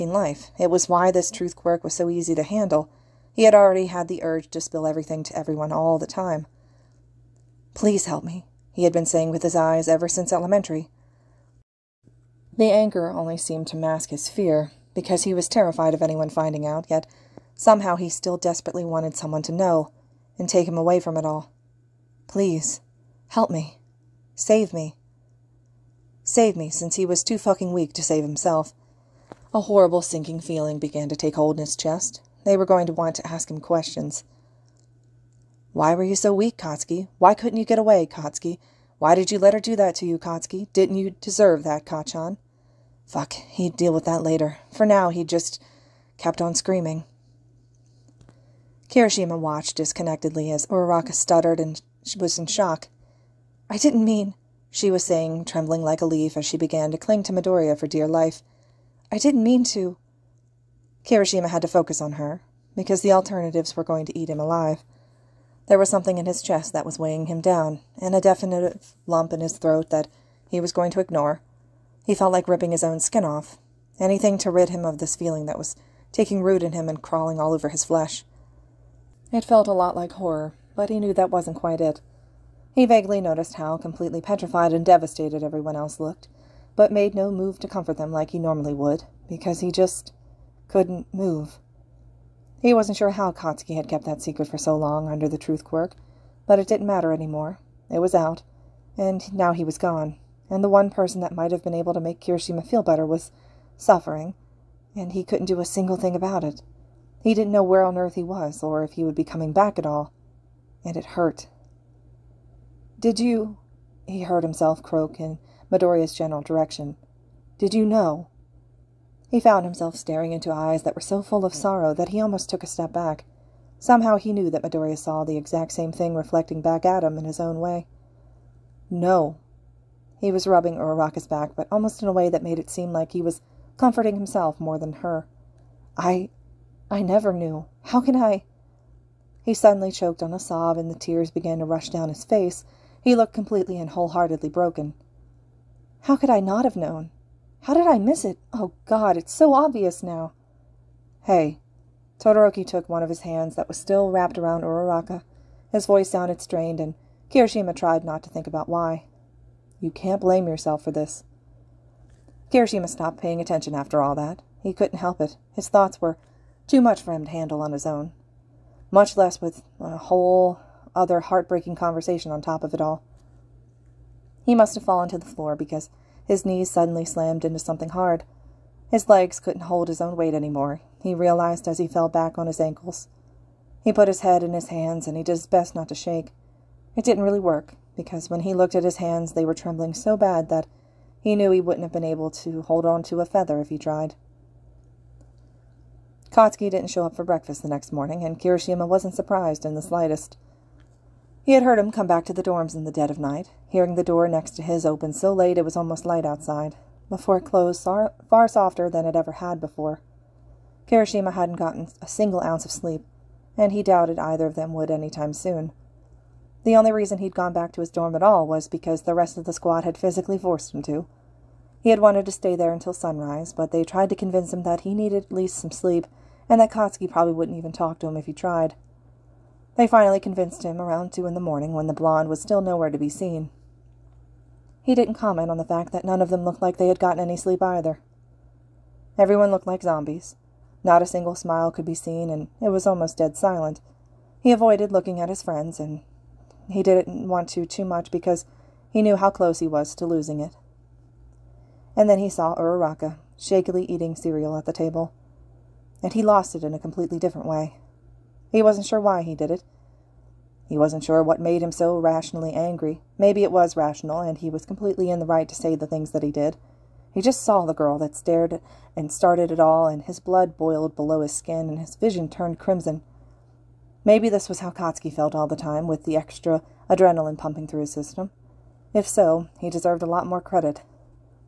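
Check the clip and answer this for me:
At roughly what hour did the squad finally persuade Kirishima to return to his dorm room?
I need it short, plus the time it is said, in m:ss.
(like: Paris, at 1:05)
2 in the morning, at 3:51.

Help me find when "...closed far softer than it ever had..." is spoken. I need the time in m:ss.
3:27.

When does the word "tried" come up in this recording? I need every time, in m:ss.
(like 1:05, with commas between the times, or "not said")
2:37, 3:13, 3:43, 3:48.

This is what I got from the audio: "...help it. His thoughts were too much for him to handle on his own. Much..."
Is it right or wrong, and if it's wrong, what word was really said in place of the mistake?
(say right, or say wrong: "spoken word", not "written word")
right.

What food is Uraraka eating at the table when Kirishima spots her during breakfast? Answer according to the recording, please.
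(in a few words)
cereal.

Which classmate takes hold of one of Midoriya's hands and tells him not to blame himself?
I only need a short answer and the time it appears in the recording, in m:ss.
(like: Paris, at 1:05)
Todoroki, at 2:32.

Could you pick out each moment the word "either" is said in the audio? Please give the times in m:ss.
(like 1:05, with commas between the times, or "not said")
3:34, 3:57.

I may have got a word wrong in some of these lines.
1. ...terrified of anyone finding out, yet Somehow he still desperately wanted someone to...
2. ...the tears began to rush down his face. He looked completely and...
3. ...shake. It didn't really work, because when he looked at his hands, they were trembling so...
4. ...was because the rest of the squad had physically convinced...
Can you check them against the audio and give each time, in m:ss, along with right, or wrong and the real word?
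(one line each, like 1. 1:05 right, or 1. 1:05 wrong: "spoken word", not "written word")
1. 0:15 right
2. 2:20 right
3. 3:05 right
4. 3:38 wrong: "forced", not "convinced".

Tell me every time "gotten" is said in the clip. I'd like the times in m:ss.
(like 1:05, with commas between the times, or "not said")
3:31, 3:56.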